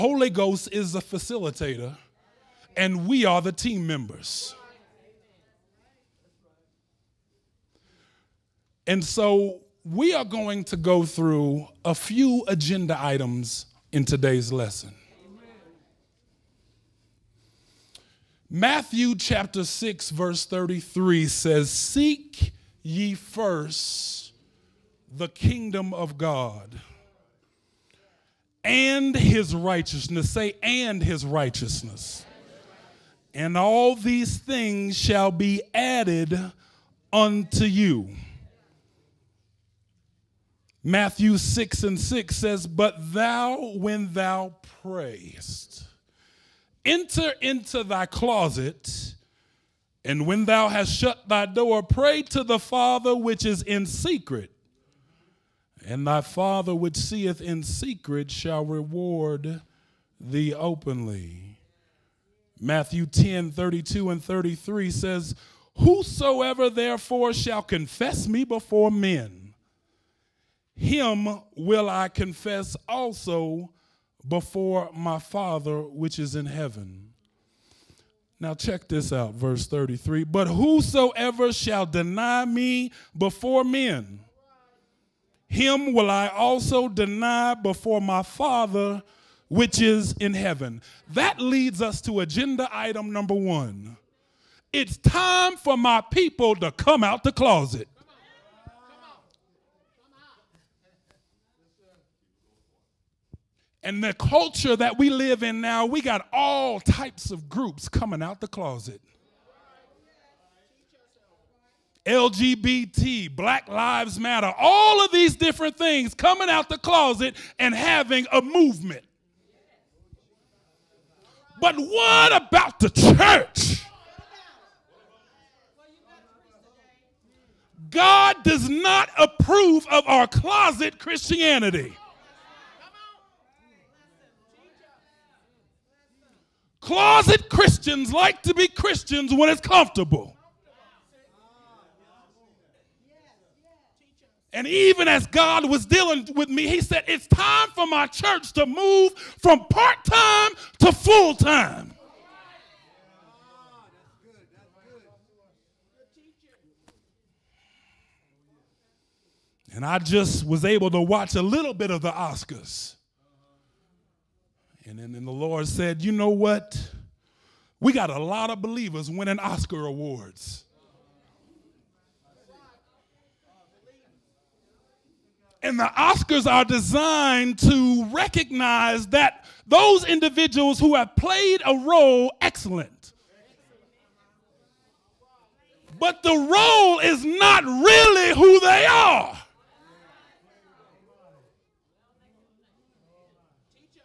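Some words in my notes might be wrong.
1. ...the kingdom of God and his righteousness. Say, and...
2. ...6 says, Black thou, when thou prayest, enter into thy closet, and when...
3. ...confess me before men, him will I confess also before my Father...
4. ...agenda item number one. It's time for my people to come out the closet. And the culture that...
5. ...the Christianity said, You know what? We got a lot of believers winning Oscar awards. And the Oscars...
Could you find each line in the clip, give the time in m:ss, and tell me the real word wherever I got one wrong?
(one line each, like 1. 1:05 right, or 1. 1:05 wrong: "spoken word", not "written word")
1. 0:25 right
2. 0:41 wrong: "But", not "Black"
3. 1:07 right
4. 1:32 right
5. 2:45 wrong: "Lord", not "Christianity".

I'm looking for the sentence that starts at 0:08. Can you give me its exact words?
And so we are going to go through a few agenda items in today's lesson.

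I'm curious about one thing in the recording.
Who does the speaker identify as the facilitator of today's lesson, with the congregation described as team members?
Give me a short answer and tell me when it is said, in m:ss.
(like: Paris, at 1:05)
Ghost, at 0:00.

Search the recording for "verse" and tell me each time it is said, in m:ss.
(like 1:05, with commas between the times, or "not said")
0:20, 1:19.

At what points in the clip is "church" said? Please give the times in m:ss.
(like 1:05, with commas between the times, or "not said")
2:02, 2:28.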